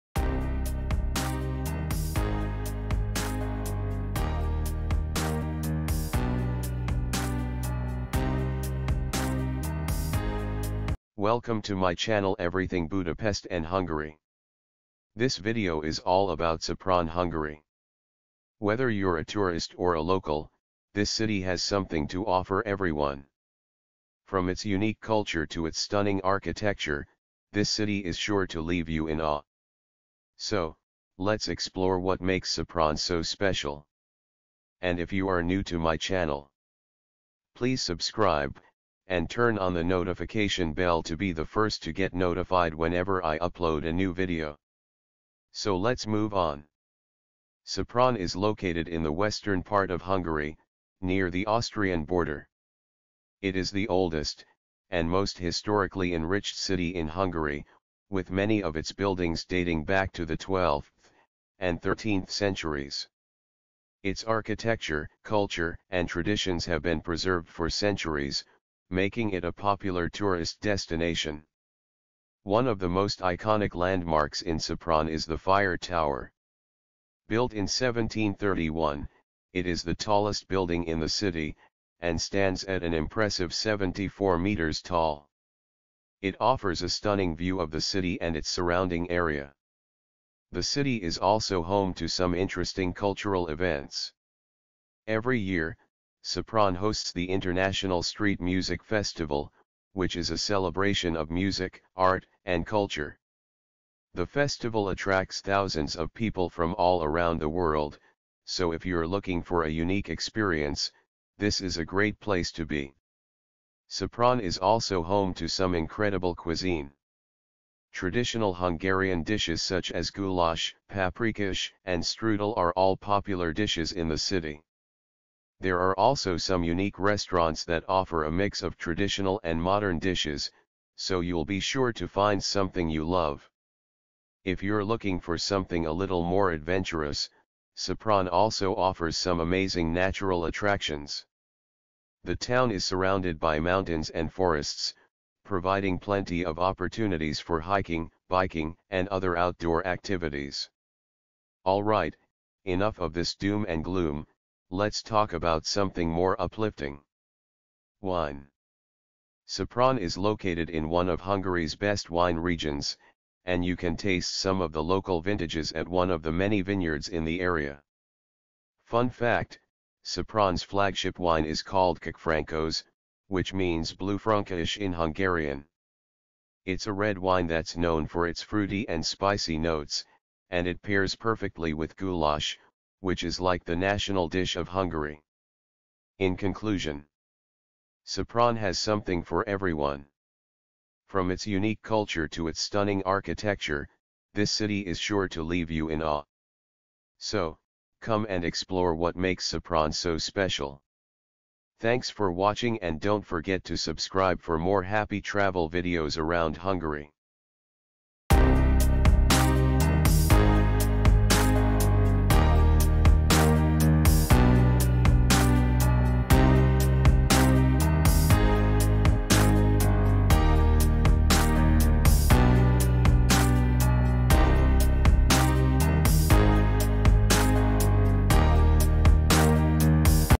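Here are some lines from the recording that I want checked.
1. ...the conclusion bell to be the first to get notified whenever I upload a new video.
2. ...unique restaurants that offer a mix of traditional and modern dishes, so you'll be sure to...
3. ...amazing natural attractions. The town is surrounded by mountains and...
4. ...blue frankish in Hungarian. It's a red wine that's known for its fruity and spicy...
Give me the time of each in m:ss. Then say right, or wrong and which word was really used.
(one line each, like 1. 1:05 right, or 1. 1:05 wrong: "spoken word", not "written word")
1. 0:39 wrong: "notification", not "conclusion"
2. 2:06 right
3. 2:19 right
4. 2:53 right.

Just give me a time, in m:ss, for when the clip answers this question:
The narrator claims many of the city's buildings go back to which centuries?
1:00.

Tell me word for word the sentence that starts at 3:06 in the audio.
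In conclusion, Sopron has something for everyone.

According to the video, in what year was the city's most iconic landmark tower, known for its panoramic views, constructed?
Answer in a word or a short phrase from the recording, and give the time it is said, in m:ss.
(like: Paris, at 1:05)
1731, at 1:17.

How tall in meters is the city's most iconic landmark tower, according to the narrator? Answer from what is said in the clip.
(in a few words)
74 meters.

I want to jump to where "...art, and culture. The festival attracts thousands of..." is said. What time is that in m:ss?
1:41.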